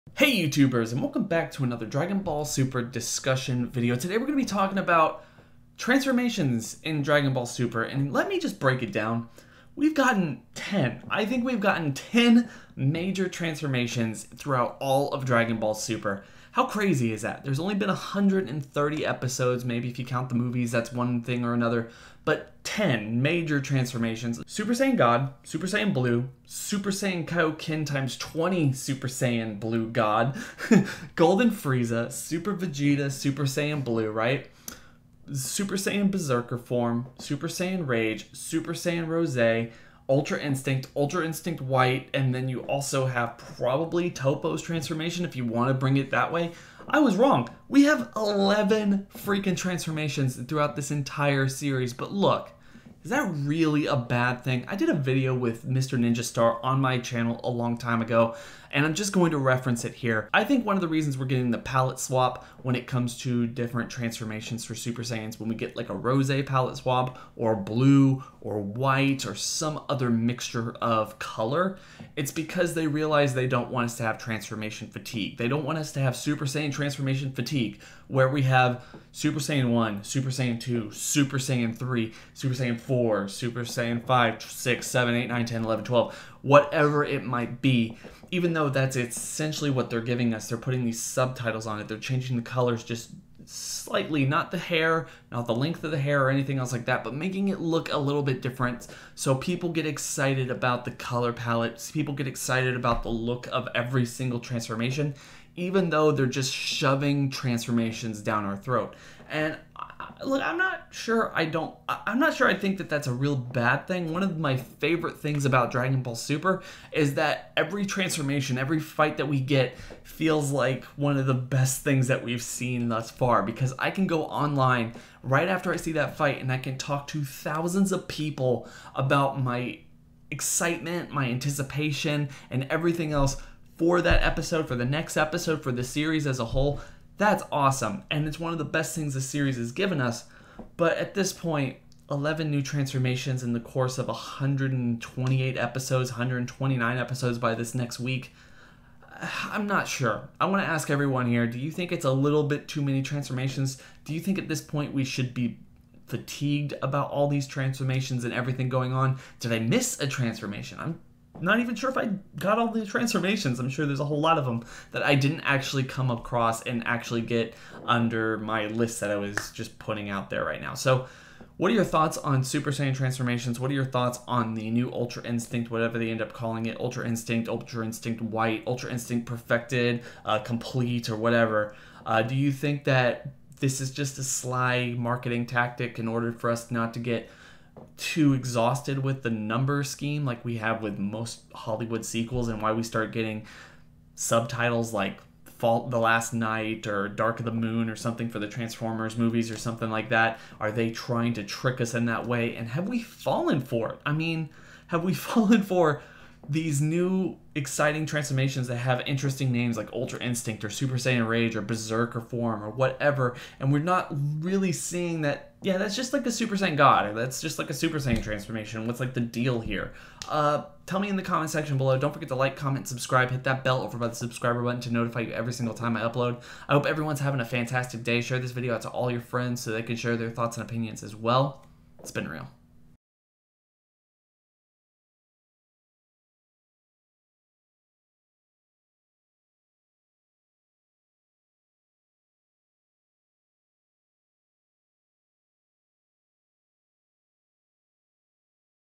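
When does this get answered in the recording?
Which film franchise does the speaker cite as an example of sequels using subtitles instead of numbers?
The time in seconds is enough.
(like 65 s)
198 s.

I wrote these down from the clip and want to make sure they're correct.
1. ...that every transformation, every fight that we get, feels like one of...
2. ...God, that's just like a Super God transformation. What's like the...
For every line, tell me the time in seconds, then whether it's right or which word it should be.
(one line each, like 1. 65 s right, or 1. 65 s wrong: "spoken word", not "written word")
1. 117 s right
2. 216 s wrong: "Saiyan", not "God".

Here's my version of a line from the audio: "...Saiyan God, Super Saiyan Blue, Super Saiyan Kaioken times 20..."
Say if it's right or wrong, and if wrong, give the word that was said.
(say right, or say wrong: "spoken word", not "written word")
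right.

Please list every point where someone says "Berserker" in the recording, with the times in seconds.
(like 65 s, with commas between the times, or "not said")
36 s, 211 s.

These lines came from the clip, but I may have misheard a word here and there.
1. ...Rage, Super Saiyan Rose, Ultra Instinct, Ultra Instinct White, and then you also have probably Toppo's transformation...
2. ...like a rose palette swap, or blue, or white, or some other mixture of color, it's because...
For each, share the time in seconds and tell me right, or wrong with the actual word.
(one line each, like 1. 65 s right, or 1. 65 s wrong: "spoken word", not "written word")
1. 37 s right
2. 65 s right.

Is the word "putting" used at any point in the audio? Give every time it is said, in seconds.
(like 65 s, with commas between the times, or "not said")
90 s, 169 s.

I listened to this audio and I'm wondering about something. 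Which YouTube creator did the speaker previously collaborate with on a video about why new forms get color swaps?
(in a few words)
Mr. Ninja Star.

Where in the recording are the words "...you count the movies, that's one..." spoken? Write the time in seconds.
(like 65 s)
19 s.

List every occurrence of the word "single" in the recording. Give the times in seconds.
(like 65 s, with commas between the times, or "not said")
104 s, 225 s.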